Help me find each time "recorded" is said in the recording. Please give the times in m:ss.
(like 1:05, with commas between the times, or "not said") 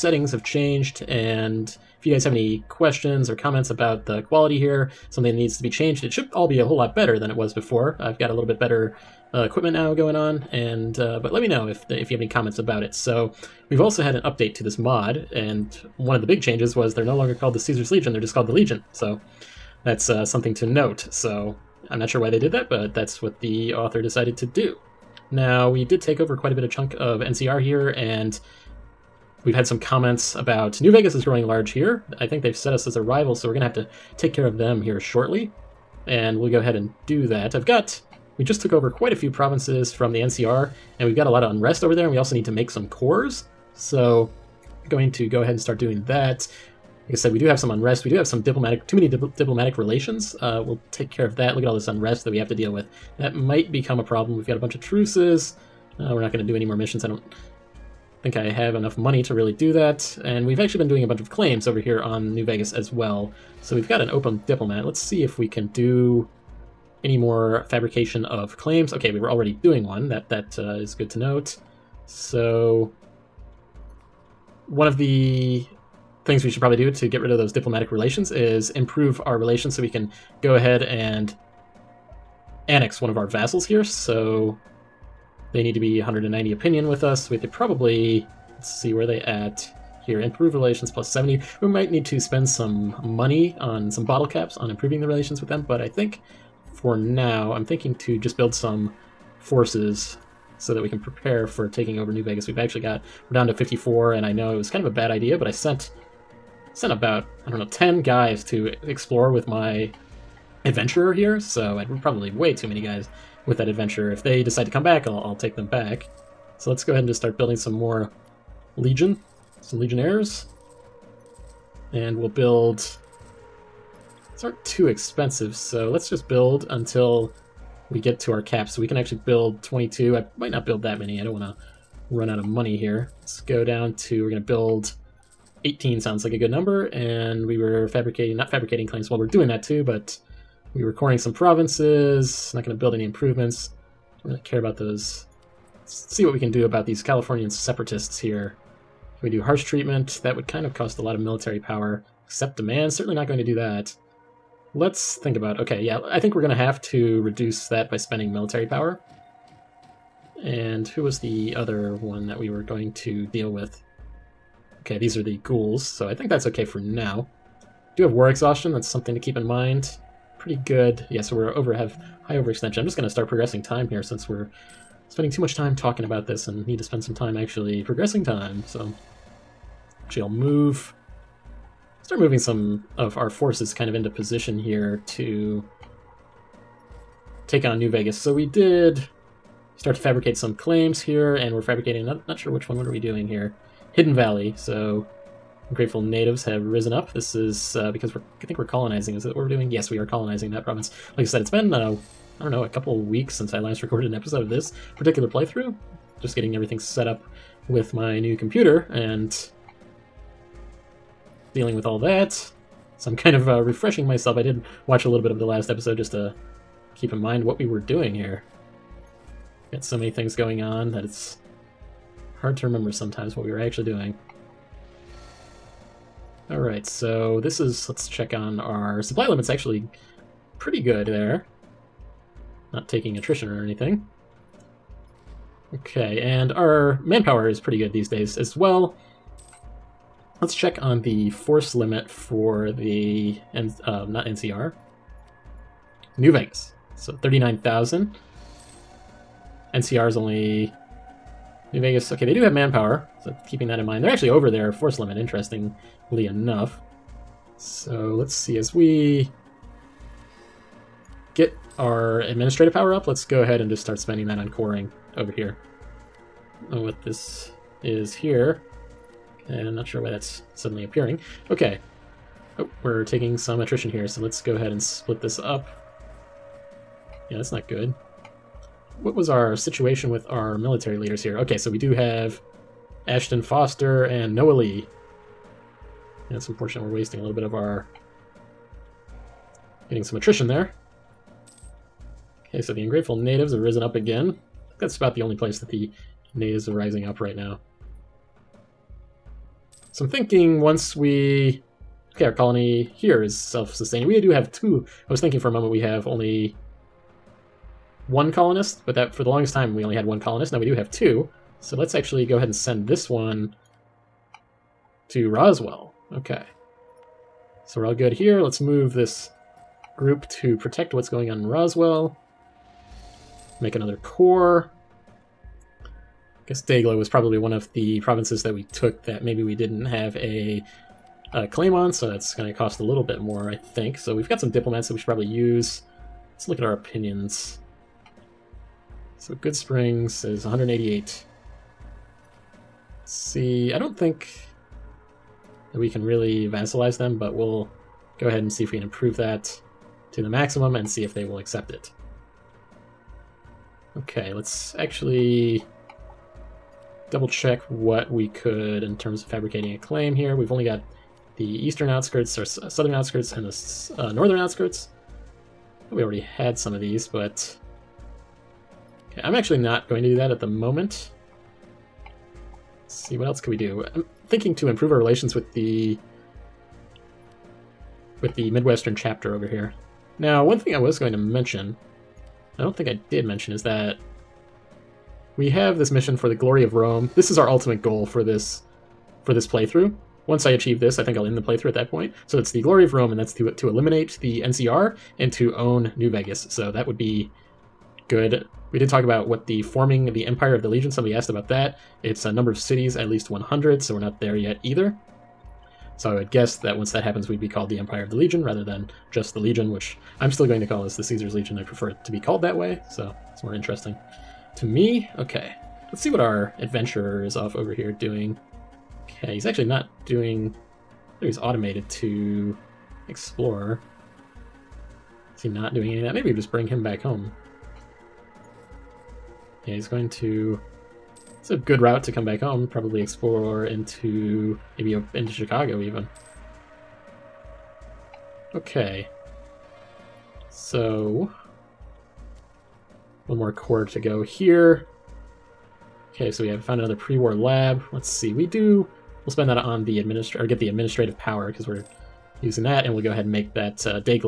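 3:23.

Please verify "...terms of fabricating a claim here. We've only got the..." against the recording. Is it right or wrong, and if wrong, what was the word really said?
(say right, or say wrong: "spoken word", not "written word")
right.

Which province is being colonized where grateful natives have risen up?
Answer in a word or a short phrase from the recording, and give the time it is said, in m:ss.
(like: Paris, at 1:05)
Hidden Valley, at 3:13.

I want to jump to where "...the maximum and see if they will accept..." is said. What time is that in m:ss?
5:50.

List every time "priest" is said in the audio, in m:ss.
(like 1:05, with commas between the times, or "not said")
not said.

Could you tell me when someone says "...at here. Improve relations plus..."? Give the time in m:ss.
1:29.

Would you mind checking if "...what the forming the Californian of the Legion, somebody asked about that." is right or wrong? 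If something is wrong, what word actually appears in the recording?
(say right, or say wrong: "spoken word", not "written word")
wrong: "Empire", not "Californian".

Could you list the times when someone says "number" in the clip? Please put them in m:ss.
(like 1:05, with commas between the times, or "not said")
2:16, 6:42.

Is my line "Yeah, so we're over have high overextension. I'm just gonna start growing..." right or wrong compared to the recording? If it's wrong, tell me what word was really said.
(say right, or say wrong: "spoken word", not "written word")
wrong: "progressing", not "growing".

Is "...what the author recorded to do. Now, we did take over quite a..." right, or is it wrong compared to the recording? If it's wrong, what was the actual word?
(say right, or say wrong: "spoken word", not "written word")
wrong: "decided", not "recorded".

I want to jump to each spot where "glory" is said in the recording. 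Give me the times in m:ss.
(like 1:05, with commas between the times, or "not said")
6:26, 6:32.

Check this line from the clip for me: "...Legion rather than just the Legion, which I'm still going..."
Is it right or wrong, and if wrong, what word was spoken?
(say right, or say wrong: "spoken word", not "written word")
right.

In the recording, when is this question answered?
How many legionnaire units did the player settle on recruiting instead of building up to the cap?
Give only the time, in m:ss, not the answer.
2:15.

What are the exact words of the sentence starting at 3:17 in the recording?
This is uh, because we're I think we're colonizing.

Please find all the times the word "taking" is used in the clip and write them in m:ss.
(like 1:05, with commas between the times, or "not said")
1:41, 3:52, 4:33.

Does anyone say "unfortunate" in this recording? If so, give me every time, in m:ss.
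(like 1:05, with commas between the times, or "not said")
4:46.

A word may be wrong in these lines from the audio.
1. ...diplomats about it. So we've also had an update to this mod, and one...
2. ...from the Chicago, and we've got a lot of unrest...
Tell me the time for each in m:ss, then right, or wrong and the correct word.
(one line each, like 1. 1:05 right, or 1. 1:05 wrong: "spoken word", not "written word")
1. 0:12 wrong: "comments", not "diplomats"
2. 0:39 wrong: "NCR", not "Chicago".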